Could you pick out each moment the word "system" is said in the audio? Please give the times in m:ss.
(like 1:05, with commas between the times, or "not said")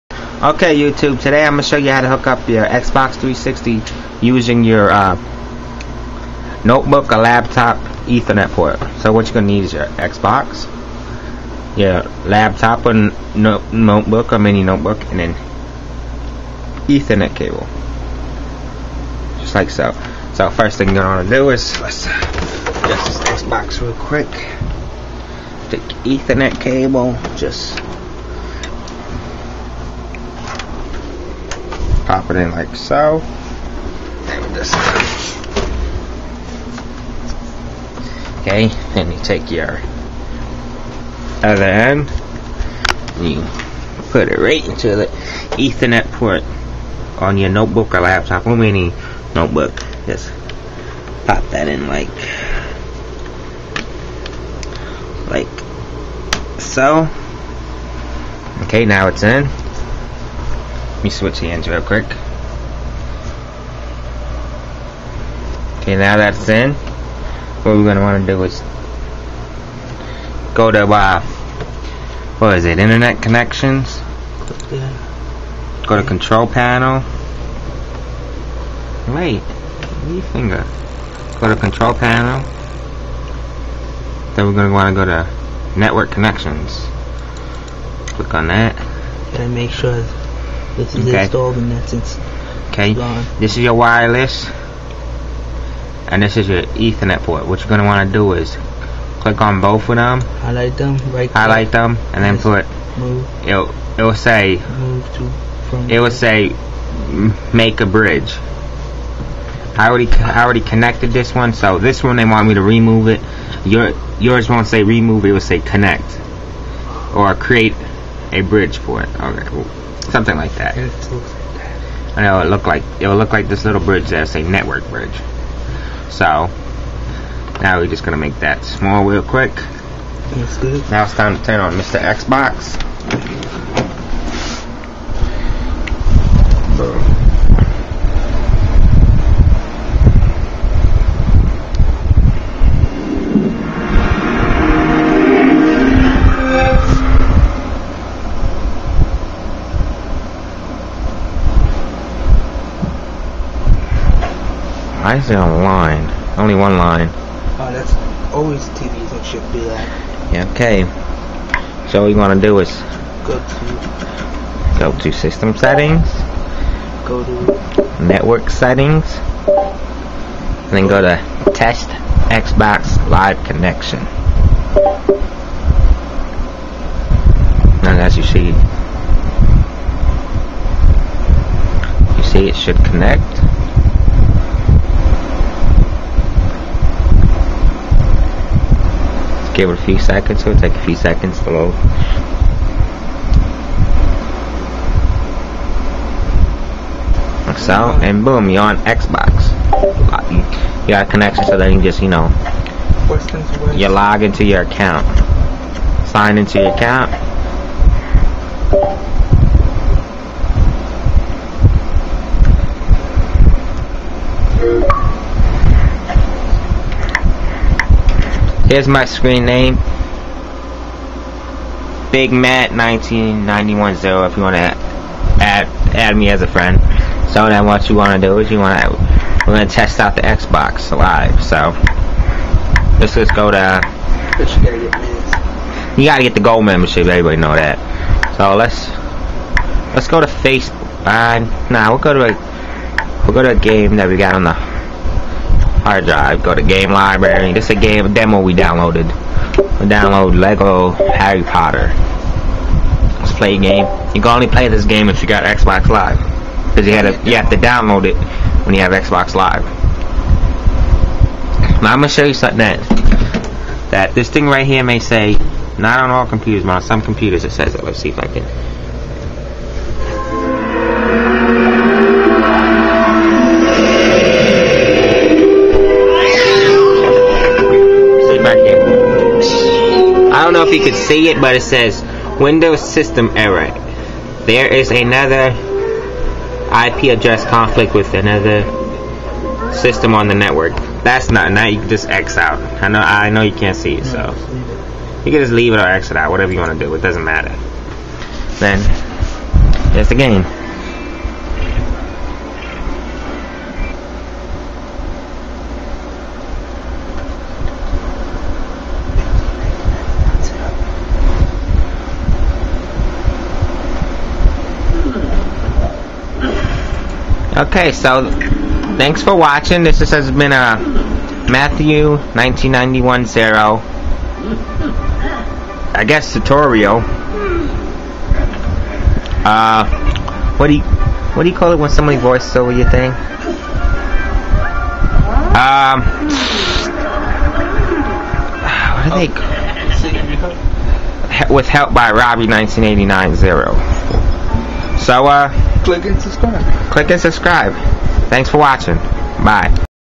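2:45, 4:42, 4:49.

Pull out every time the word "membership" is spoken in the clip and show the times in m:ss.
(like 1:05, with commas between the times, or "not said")
3:56.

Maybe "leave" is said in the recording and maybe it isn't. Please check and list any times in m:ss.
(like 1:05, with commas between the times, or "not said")
1:20, 4:55.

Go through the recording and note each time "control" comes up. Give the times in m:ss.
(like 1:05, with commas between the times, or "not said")
1:16, 1:21.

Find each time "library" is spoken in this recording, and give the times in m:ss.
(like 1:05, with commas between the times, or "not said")
4:06.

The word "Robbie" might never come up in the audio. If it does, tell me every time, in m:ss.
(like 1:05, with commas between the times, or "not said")
5:42.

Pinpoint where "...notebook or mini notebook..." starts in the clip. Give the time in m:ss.
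0:13.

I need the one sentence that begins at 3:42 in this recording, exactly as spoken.
Big Matt 19910 if you want to add, add me as a friend.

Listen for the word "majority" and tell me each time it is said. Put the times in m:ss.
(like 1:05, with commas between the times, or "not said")
not said.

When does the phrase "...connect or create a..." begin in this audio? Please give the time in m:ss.
1:55.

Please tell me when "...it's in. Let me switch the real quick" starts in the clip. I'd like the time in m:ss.
0:59.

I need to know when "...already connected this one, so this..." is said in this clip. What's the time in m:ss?
1:50.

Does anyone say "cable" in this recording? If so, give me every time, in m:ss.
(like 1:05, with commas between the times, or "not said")
0:17, 0:26.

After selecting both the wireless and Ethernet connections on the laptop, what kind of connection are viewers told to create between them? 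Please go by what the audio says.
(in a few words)
Network bridge.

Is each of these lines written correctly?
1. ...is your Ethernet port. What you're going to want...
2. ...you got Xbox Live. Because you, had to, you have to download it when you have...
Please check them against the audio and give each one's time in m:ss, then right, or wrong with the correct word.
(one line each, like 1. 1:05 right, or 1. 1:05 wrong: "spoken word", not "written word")
1. 1:36 right
2. 4:15 right.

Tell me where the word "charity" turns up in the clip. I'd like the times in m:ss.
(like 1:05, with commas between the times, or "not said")
not said.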